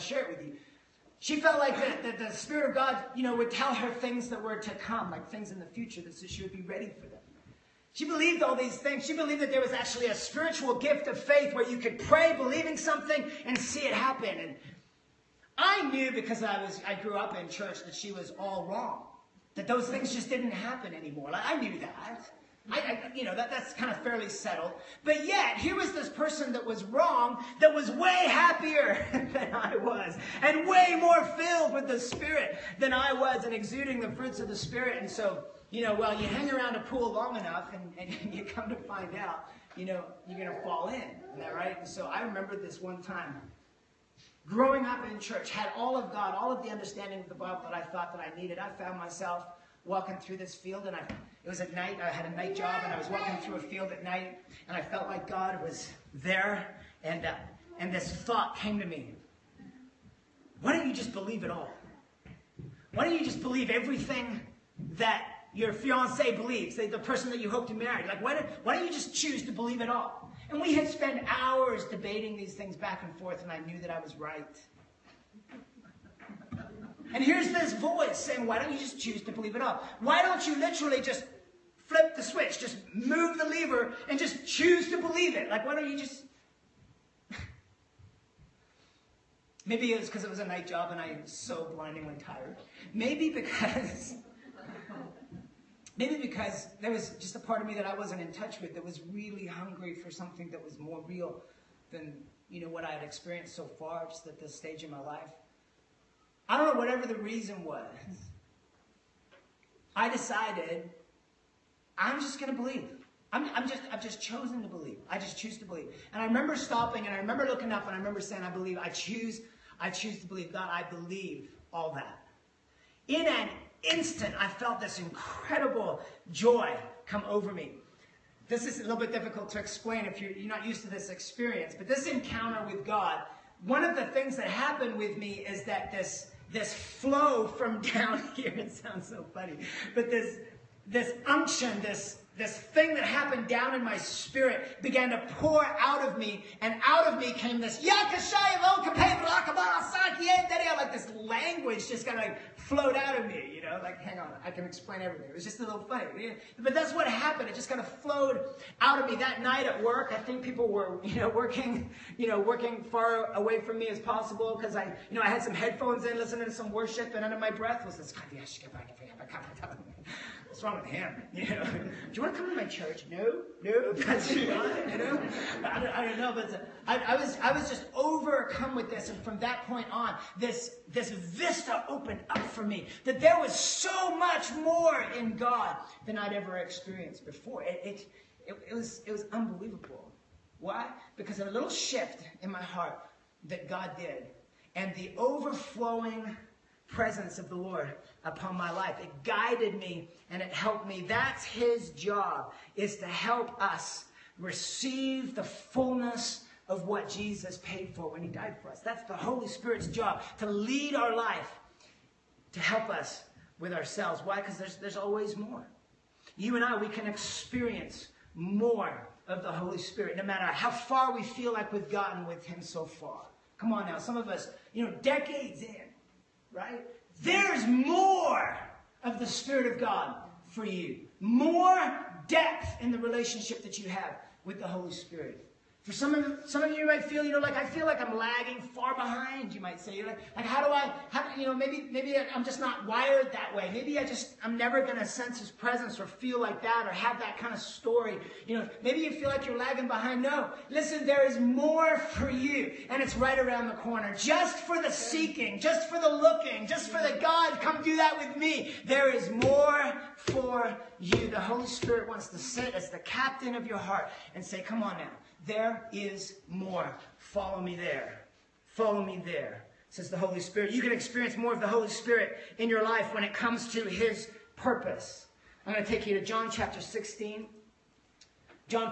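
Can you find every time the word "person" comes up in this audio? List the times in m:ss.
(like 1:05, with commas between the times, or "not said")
0:26, 1:06.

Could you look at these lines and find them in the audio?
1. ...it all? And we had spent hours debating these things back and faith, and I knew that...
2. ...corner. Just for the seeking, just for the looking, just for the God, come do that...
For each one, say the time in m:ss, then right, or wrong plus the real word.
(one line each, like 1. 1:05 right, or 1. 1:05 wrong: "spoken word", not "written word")
1. 1:09 wrong: "forth", not "faith"
2. 4:13 right.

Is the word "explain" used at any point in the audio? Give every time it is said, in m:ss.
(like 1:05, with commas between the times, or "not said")
2:09, 2:34.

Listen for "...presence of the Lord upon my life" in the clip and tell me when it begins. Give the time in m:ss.
3:16.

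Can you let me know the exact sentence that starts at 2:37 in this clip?
It just kind of flowed out of me that night at work.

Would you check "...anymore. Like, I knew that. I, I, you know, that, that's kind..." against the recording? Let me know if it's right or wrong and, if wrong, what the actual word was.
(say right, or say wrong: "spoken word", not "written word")
right.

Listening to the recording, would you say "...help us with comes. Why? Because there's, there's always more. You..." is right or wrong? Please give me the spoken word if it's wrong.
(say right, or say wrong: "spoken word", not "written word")
wrong: "ourselves", not "comes".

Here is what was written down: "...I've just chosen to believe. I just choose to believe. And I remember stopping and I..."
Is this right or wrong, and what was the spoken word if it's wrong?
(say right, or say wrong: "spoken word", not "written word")
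right.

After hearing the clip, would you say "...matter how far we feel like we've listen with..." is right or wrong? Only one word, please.
wrong.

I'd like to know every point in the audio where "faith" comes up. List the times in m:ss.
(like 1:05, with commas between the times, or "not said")
0:11.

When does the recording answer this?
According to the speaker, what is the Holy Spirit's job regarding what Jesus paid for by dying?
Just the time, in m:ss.
3:24.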